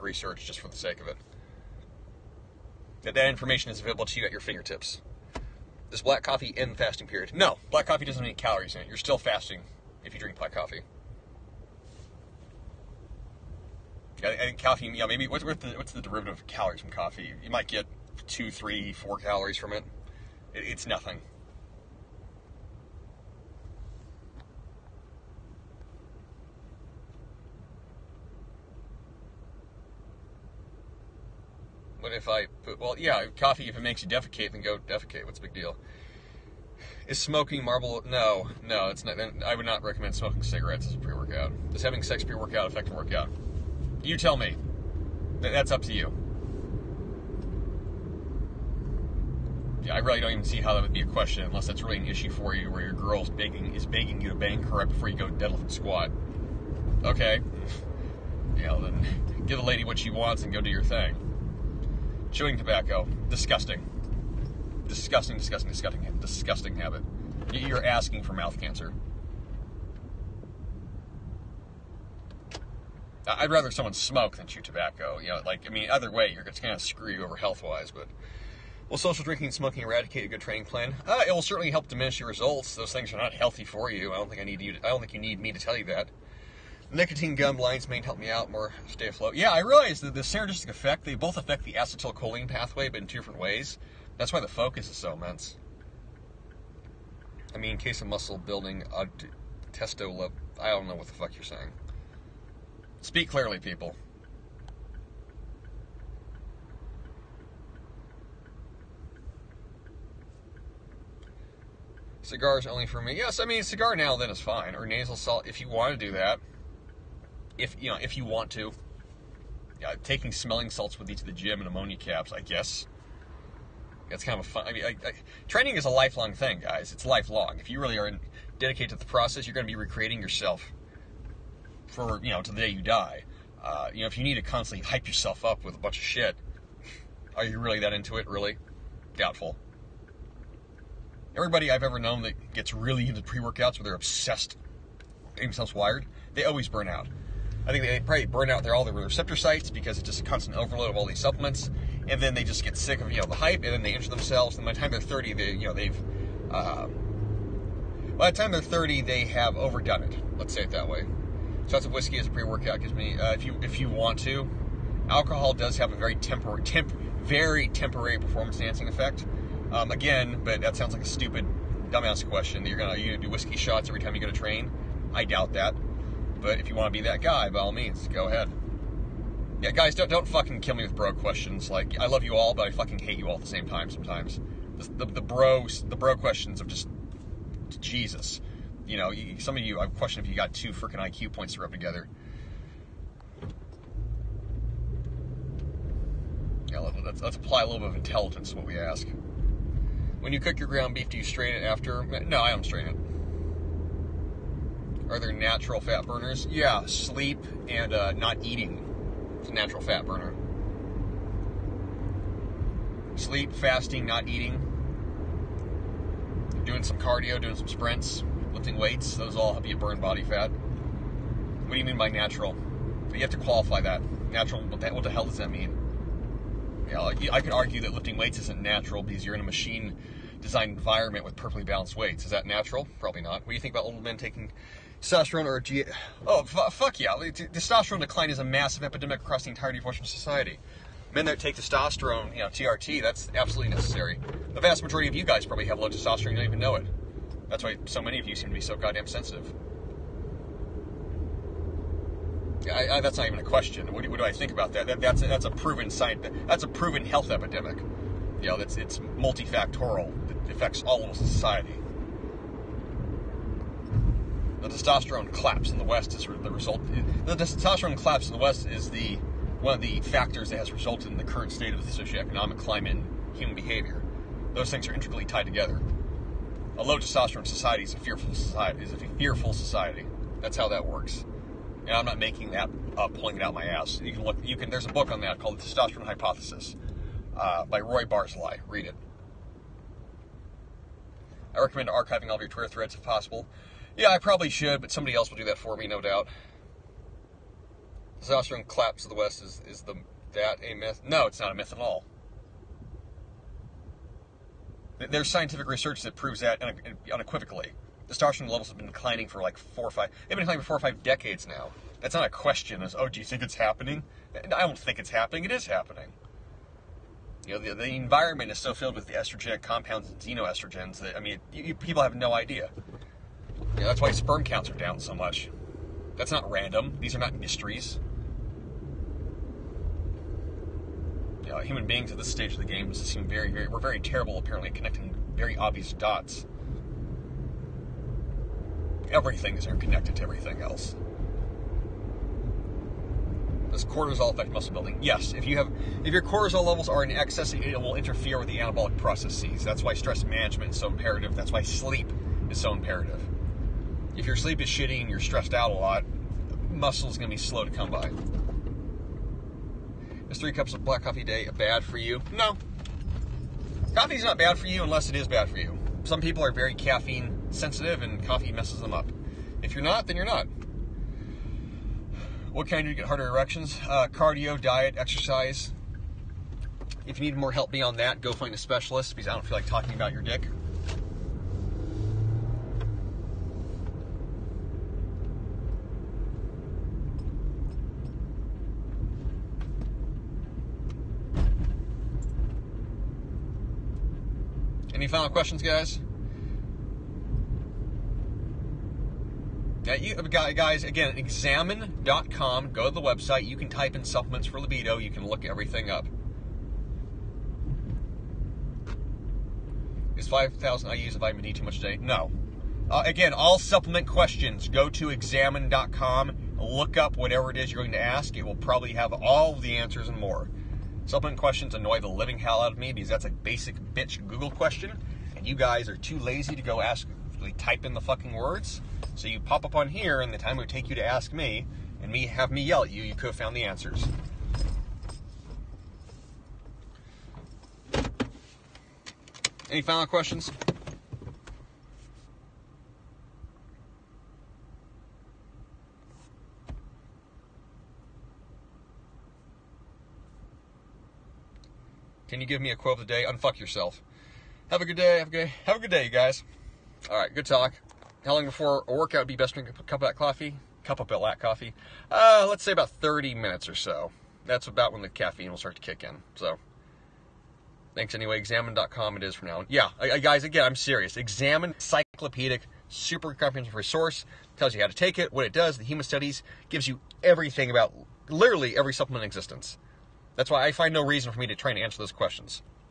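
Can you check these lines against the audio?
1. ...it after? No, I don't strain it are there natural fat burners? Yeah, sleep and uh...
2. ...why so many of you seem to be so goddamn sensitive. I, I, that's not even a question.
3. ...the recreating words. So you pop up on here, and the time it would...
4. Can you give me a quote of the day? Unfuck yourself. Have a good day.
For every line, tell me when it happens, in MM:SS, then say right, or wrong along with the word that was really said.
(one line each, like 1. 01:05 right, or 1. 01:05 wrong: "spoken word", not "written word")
1. 03:21 right
2. 04:07 right
3. 07:07 wrong: "fucking", not "recreating"
4. 07:32 right.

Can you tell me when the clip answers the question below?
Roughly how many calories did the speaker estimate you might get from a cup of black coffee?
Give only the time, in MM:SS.
00:18.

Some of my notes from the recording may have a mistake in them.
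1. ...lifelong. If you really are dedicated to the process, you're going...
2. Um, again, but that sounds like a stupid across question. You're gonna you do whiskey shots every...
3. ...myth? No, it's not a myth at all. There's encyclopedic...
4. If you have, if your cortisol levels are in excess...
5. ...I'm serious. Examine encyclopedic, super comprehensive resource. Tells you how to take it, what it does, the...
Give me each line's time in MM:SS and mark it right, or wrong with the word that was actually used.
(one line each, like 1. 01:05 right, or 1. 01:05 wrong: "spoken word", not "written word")
1. 02:07 right
2. 02:49 wrong: "dumbass", not "across"
3. 05:00 wrong: "scientific", not "encyclopedic"
4. 05:45 right
5. 07:50 right.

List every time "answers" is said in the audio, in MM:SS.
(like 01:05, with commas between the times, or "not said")
06:59, 07:13, 08:01.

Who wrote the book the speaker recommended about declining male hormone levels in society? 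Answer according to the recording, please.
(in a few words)
Roy Barzilai.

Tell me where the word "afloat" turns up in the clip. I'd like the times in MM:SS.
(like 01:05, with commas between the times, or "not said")
01:29.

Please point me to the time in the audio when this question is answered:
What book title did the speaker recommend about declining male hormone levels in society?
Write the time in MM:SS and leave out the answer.
04:45.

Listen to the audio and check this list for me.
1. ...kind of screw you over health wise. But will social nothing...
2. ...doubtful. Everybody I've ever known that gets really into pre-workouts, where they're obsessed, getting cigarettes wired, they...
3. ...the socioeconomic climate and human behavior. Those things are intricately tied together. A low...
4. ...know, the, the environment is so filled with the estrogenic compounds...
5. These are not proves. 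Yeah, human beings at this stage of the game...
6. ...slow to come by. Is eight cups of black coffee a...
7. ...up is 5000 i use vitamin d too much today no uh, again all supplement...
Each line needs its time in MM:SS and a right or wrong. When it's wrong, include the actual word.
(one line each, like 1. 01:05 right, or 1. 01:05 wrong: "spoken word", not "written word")
1. 01:16 wrong: "drinking", not "nothing"
2. 02:19 wrong: "themselves", not "cigarettes"
3. 04:31 right
4. 05:17 right
5. 05:26 wrong: "mysteries", not "proves"
6. 05:57 wrong: "three", not "eight"
7. 06:45 right.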